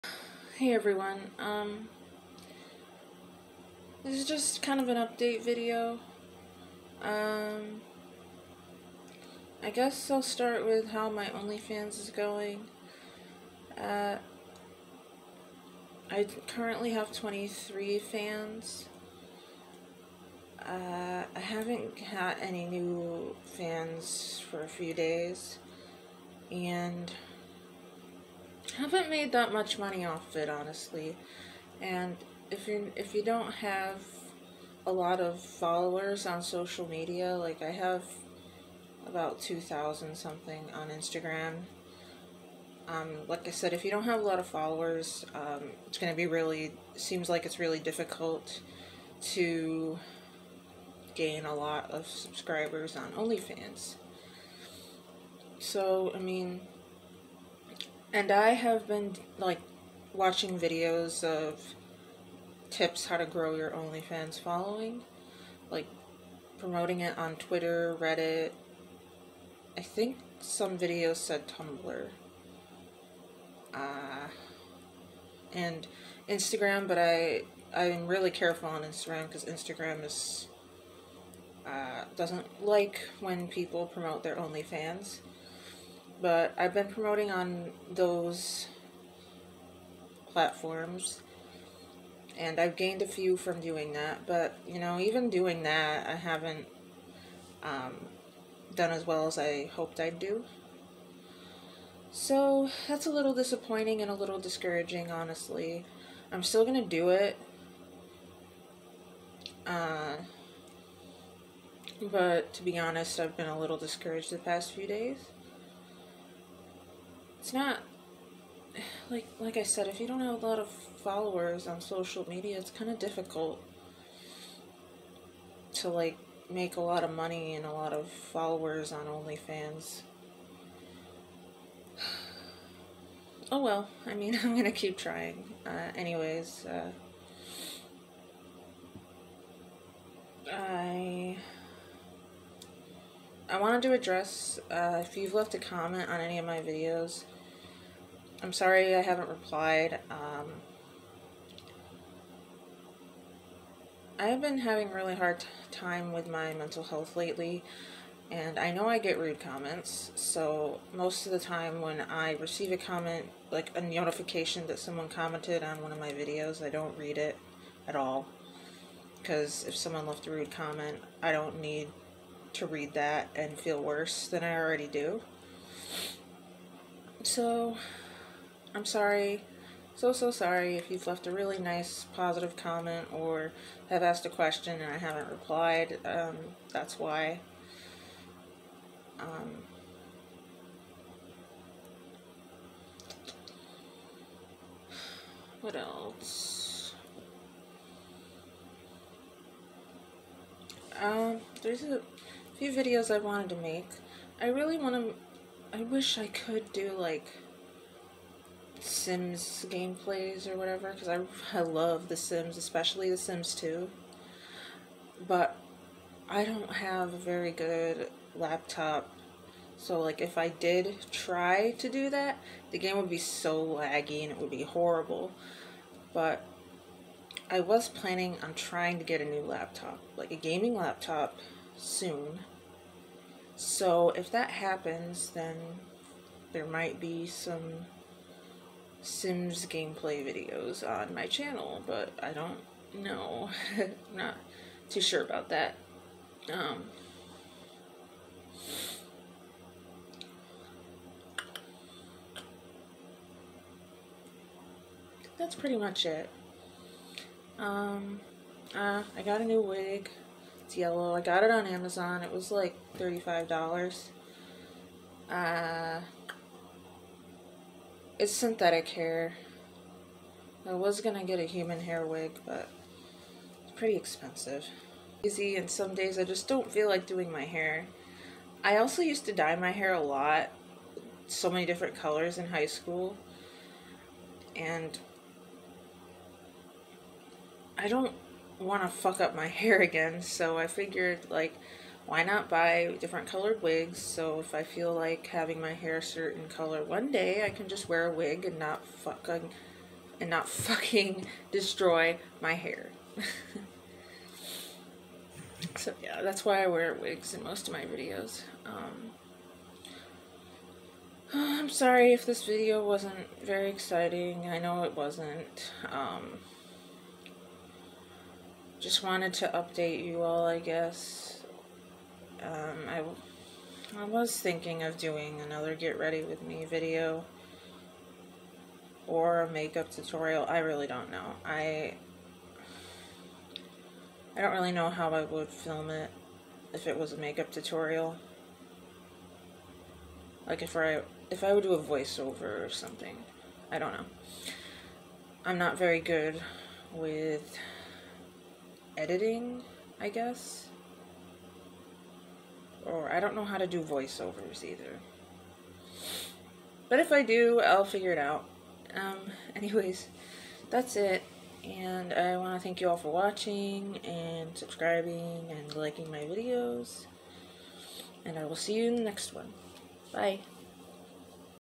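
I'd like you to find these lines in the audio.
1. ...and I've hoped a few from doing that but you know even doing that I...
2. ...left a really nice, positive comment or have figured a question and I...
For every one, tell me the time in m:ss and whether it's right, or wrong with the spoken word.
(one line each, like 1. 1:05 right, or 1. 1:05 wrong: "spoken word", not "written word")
1. 1:32 wrong: "gained", not "hoped"
2. 3:01 wrong: "asked", not "figured".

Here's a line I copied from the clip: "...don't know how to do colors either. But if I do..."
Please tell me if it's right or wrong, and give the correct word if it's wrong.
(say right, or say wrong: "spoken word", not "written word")
wrong: "voiceovers", not "colors".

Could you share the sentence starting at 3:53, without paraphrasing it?
So if that happens, then there might be some Sims gameplay videos on my channel, but I don't know.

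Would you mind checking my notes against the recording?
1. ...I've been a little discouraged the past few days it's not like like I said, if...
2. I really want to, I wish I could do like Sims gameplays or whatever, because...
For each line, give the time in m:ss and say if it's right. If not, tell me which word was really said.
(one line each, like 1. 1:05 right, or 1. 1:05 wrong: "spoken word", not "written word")
1. 1:53 right
2. 3:24 right.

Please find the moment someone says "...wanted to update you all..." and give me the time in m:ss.
5:19.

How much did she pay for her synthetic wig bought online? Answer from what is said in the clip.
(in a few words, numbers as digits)
$35.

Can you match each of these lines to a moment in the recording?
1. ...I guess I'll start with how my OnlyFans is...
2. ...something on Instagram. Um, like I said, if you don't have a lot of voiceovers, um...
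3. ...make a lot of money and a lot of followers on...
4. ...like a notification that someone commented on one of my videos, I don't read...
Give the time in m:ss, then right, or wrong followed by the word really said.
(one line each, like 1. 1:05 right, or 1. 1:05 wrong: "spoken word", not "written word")
1. 0:09 right
2. 0:40 wrong: "followers", not "voiceovers"
3. 2:06 right
4. 2:43 right.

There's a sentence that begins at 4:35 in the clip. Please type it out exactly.
Easy, and some days I just don't feel like doing my hair.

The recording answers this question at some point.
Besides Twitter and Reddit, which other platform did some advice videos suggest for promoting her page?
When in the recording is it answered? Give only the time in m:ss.
1:11.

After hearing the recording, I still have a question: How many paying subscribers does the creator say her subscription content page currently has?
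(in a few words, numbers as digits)
23.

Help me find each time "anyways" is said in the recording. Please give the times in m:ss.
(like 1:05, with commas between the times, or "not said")
2:15, 5:59.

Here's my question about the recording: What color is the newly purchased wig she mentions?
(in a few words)
Yellow.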